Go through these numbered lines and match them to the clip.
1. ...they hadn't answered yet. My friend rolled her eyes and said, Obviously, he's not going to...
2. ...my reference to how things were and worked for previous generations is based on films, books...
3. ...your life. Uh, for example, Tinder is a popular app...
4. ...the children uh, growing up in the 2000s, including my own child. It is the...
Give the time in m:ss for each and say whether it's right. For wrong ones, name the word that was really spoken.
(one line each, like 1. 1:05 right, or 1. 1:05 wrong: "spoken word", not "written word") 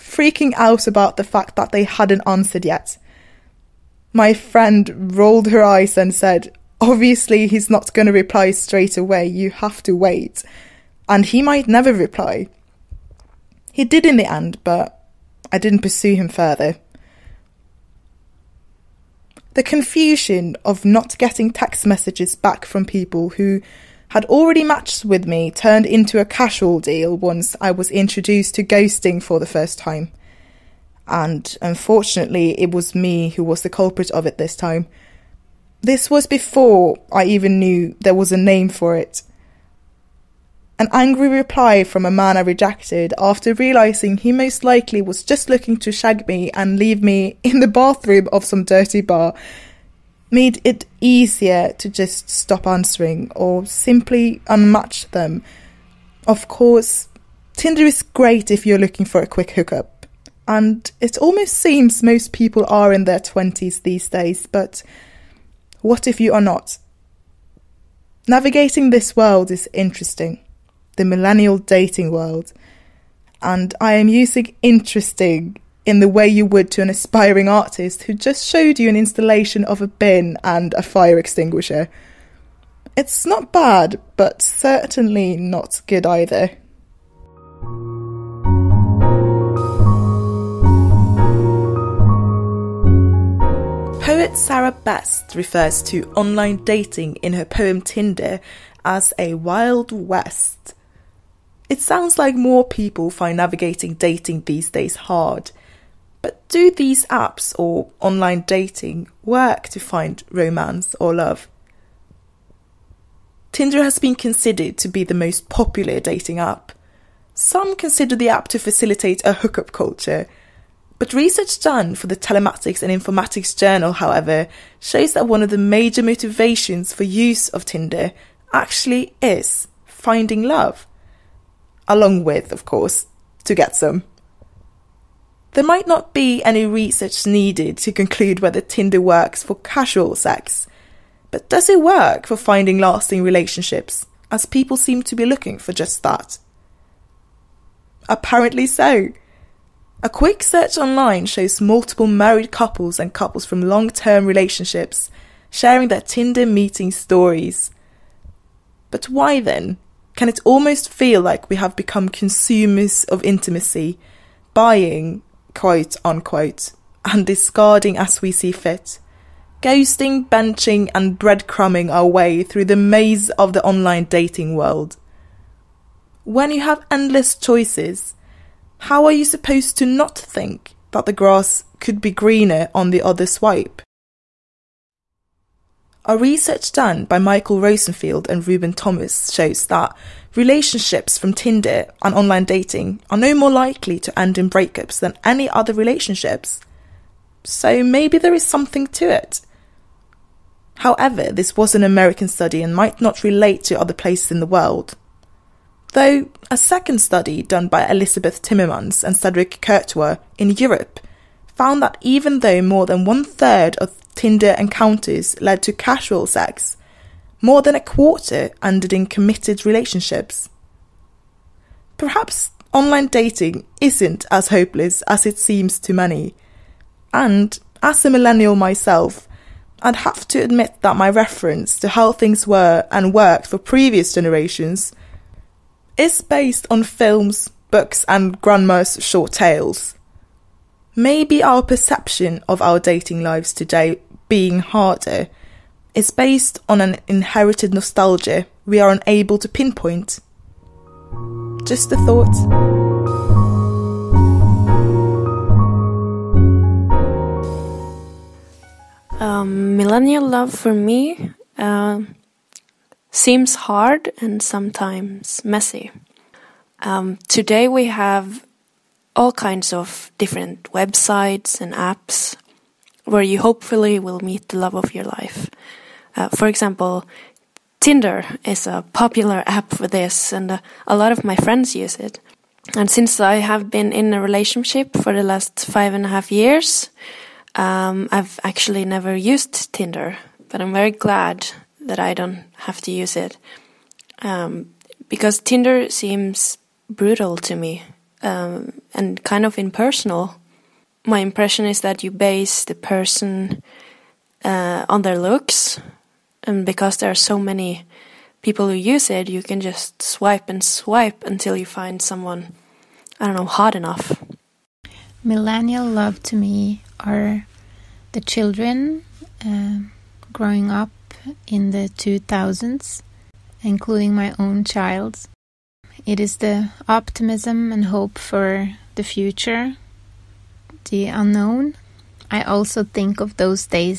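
1. 0:01 right
2. 3:50 right
3. 4:34 right
4. 5:18 right.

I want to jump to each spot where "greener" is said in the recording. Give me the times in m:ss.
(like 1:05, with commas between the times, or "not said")
3:02.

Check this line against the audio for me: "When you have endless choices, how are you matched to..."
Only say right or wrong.
wrong.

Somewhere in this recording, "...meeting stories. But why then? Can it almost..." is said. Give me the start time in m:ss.
2:36.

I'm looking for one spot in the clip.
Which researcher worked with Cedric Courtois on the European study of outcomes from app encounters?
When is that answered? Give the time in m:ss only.
3:27.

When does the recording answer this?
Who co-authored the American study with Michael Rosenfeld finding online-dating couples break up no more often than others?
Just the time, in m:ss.
3:08.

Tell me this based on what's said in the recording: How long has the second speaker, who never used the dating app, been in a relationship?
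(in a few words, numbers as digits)
5 and a half years.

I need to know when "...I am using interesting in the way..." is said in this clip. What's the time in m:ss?
1:13.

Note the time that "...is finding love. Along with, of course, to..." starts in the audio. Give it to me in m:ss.
2:09.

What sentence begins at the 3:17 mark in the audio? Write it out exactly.
So maybe there is something to it.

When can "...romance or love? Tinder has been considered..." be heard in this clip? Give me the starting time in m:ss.
1:50.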